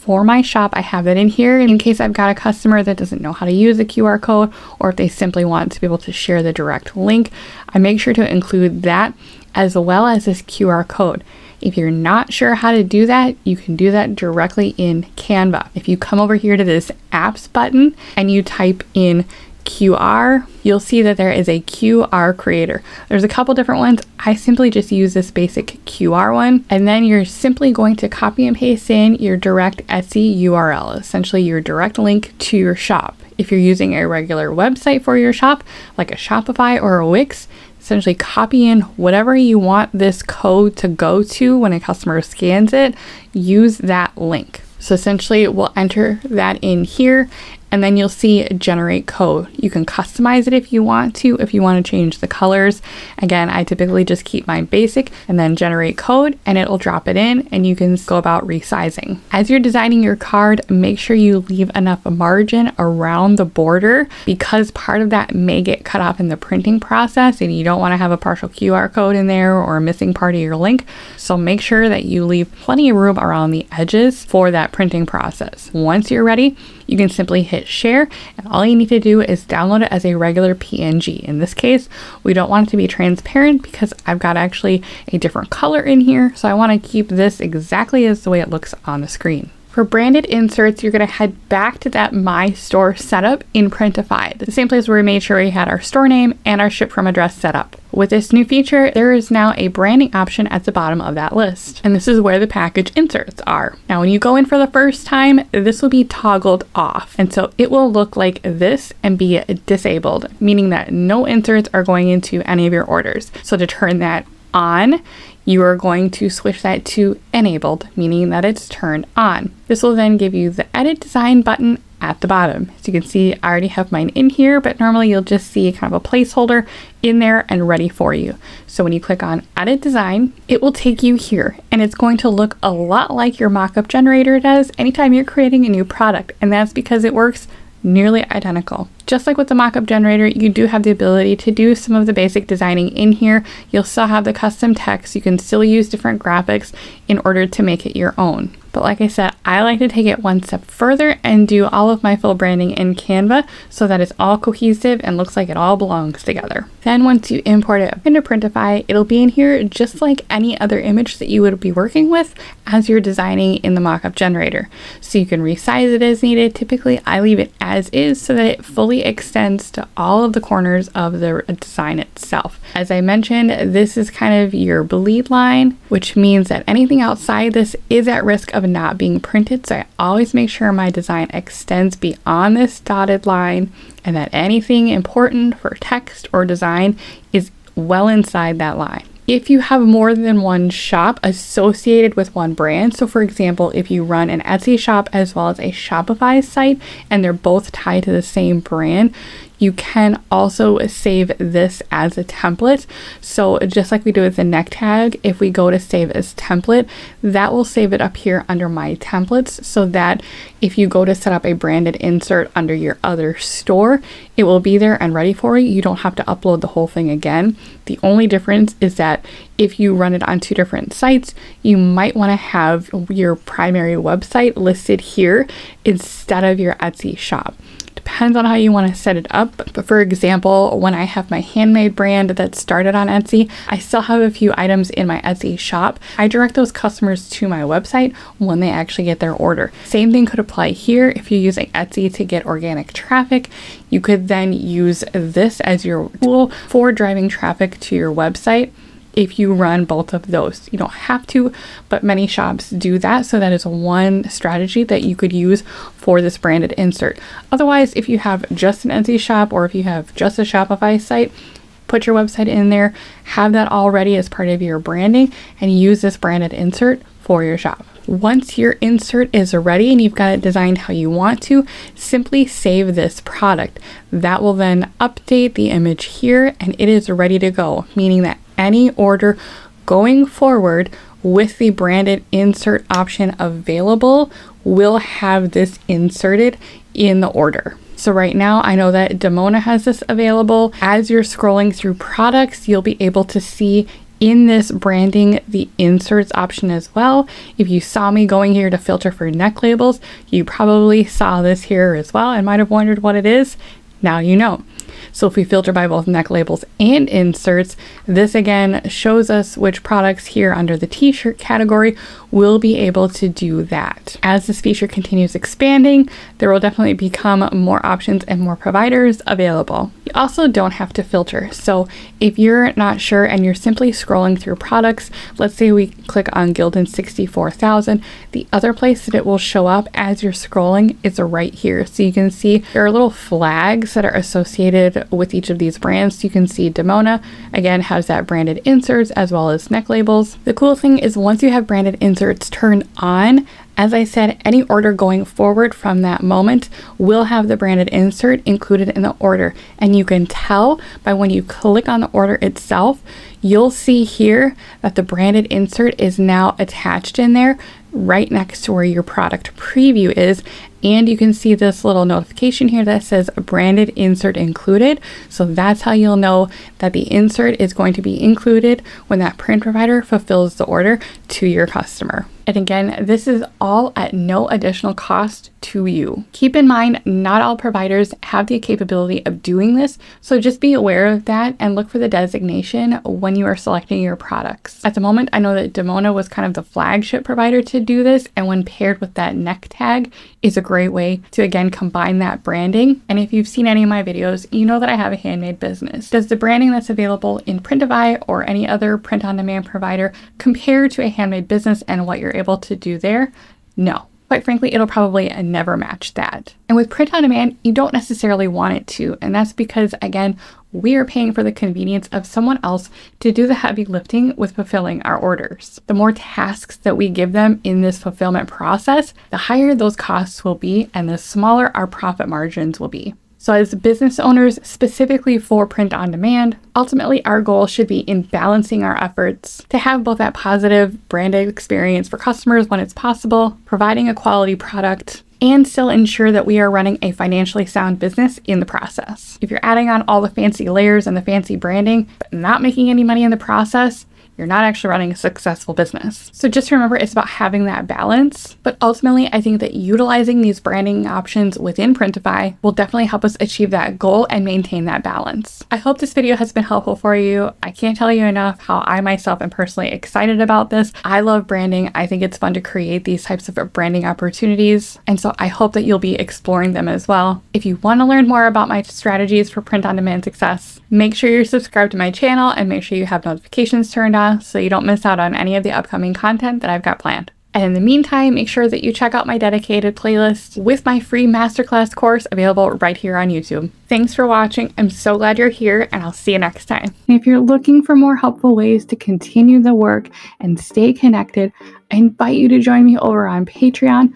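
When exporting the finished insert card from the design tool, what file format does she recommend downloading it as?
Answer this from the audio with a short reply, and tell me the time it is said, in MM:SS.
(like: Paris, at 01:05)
PNG, at 01:20.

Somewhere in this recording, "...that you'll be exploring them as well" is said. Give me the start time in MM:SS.
07:45.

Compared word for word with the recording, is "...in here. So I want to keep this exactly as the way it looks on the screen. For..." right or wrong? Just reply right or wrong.
right.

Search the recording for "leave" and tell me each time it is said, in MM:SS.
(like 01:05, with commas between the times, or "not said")
01:01, 01:12, 02:47.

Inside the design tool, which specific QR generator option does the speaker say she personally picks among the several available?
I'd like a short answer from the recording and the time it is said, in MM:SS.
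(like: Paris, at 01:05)
basic QR, at 00:25.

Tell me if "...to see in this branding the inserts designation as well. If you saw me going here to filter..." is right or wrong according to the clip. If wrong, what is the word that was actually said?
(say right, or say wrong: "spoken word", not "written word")
wrong: "option", not "designation".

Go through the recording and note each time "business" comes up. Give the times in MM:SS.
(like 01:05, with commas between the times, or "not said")
06:35, 06:41, 07:03, 07:17, 07:25.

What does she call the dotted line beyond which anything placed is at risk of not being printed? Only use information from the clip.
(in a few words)
bleed line.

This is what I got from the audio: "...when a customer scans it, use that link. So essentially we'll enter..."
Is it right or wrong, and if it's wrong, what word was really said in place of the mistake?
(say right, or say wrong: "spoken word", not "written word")
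right.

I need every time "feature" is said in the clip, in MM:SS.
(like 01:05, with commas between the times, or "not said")
01:38, 05:14.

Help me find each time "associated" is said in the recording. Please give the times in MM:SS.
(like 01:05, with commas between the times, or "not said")
03:11, 05:34.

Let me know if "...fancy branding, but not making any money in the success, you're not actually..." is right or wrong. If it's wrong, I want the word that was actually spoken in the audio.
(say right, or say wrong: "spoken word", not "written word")
wrong: "process", not "success".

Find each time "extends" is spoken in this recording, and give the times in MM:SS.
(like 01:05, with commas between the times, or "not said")
02:49, 03:01.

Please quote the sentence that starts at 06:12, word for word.
And again, this is all at no additional cost to you.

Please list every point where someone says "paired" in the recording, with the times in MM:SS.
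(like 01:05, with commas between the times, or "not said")
06:28.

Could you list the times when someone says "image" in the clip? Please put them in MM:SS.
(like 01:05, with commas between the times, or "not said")
02:40, 04:35.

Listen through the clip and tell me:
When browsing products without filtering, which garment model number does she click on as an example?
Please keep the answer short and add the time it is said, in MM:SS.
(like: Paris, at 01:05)
Gildan 64000, at 05:26.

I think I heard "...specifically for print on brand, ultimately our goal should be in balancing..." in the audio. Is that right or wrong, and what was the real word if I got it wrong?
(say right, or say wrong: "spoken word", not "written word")
wrong: "demand", not "brand".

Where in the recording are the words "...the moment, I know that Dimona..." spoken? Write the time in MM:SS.
06:24.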